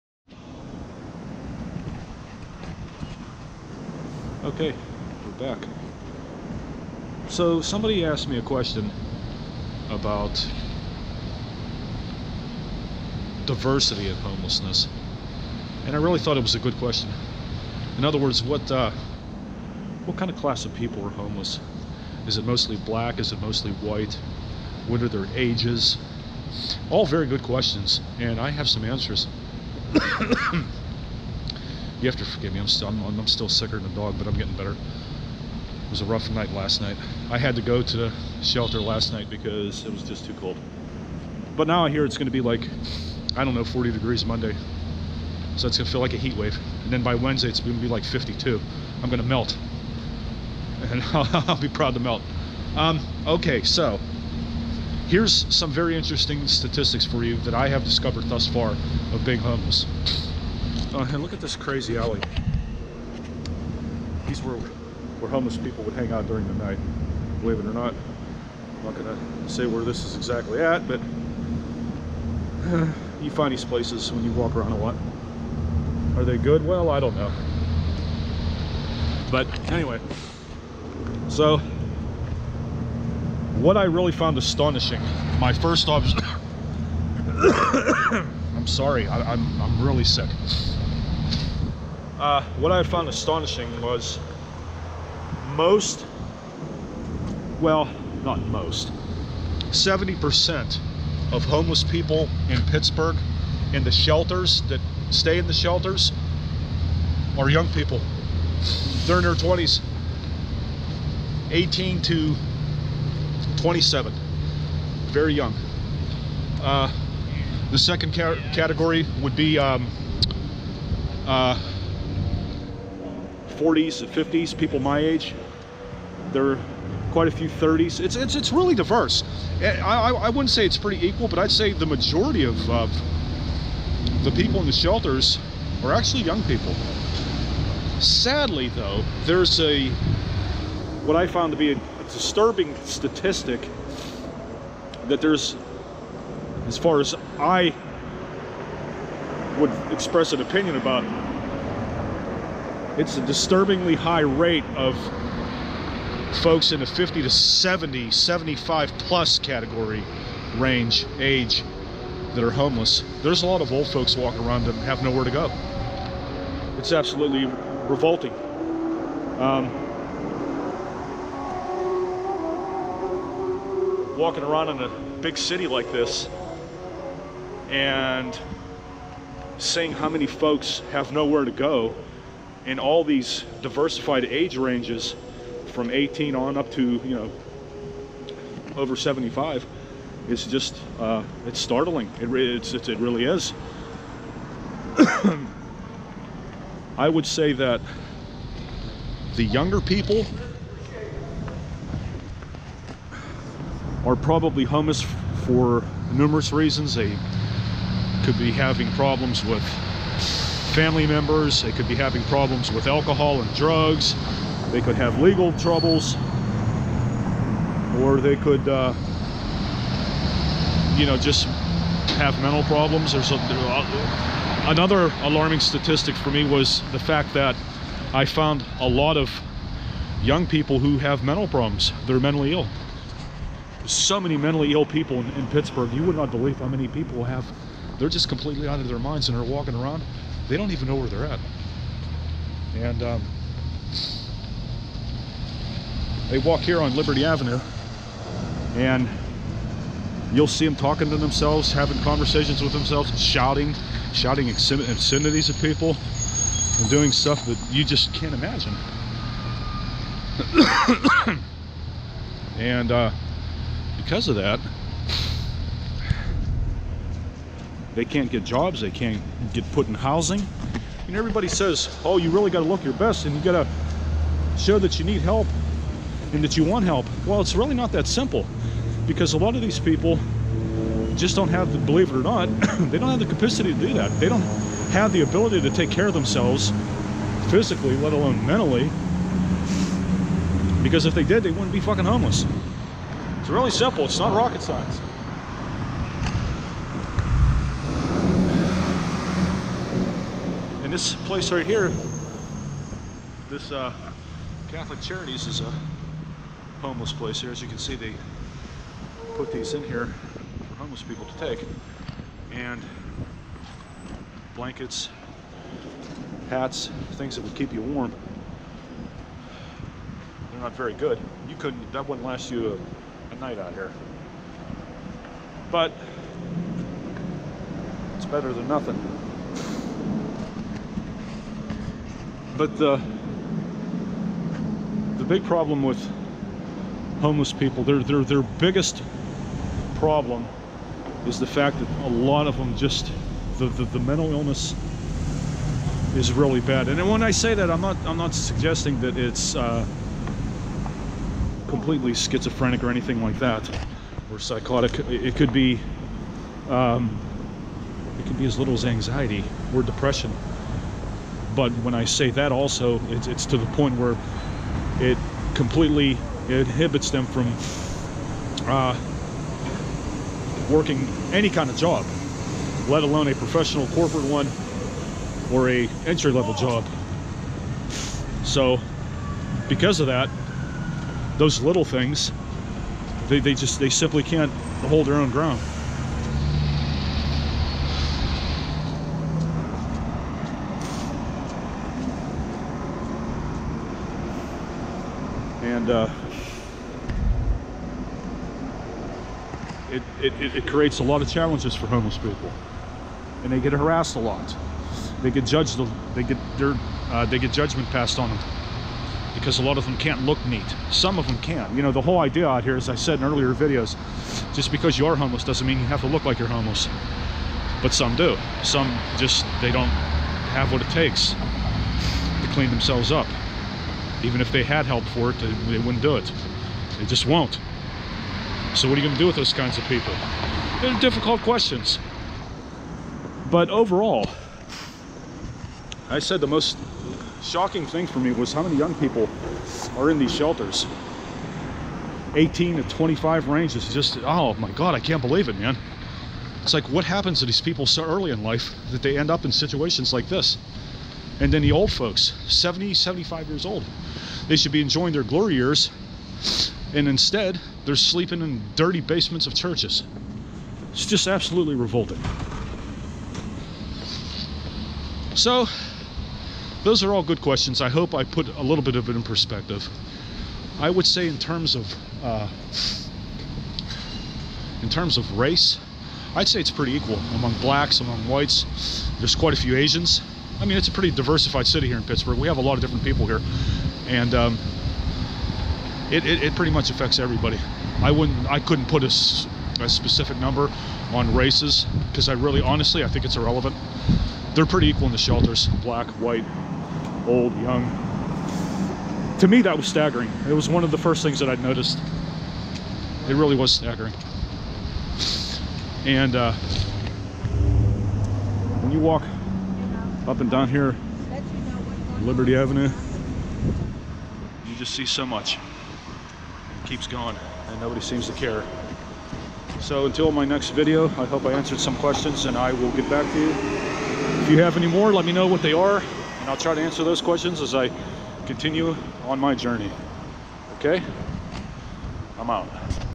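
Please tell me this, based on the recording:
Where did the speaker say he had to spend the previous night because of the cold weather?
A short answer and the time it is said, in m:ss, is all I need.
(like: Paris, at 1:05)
the shelter, at 0:37.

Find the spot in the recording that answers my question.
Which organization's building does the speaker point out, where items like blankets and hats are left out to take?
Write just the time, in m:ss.
5:04.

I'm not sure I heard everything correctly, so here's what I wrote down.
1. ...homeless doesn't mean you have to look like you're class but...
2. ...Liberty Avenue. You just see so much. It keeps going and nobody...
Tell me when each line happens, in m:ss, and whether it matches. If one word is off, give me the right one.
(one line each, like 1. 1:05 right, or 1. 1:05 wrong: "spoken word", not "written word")
1. 6:55 wrong: "homeless", not "class"
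2. 8:32 right.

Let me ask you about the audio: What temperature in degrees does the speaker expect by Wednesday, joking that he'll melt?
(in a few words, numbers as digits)
52.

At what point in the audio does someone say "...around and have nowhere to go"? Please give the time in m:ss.
2:44.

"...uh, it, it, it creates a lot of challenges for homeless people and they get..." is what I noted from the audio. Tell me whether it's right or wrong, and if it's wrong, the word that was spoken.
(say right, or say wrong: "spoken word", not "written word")
right.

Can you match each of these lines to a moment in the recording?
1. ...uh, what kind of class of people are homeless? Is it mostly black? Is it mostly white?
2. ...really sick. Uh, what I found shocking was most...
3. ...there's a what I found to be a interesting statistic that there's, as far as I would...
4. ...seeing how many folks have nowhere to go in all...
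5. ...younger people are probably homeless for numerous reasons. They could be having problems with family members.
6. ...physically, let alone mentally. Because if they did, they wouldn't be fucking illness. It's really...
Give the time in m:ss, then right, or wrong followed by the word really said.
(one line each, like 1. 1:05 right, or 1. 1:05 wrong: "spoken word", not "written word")
1. 0:18 right
2. 1:29 wrong: "astonishing", not "shocking"
3. 2:19 wrong: "disturbing", not "interesting"
4. 2:59 right
5. 3:19 right
6. 4:47 wrong: "homeless", not "illness".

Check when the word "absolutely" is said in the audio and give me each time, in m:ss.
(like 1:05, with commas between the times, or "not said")
2:46, 7:41.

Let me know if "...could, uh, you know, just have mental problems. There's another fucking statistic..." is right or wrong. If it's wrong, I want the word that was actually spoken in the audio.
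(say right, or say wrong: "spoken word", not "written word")
wrong: "alarming", not "fucking".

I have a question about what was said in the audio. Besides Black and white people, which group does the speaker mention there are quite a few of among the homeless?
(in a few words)
Asians.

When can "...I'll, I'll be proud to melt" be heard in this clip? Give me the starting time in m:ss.
0:51.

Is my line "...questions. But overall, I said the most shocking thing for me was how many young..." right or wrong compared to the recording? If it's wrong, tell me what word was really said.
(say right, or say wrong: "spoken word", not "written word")
right.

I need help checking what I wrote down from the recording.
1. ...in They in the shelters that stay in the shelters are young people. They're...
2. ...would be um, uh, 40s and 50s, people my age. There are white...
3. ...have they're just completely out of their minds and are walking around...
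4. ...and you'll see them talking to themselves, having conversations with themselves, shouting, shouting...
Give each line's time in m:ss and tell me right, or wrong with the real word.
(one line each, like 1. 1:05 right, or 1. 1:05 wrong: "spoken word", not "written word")
1. 1:42 wrong: "Pittsburgh", not "They"
2. 1:59 wrong: "quite", not "white"
3. 3:57 right
4. 4:08 right.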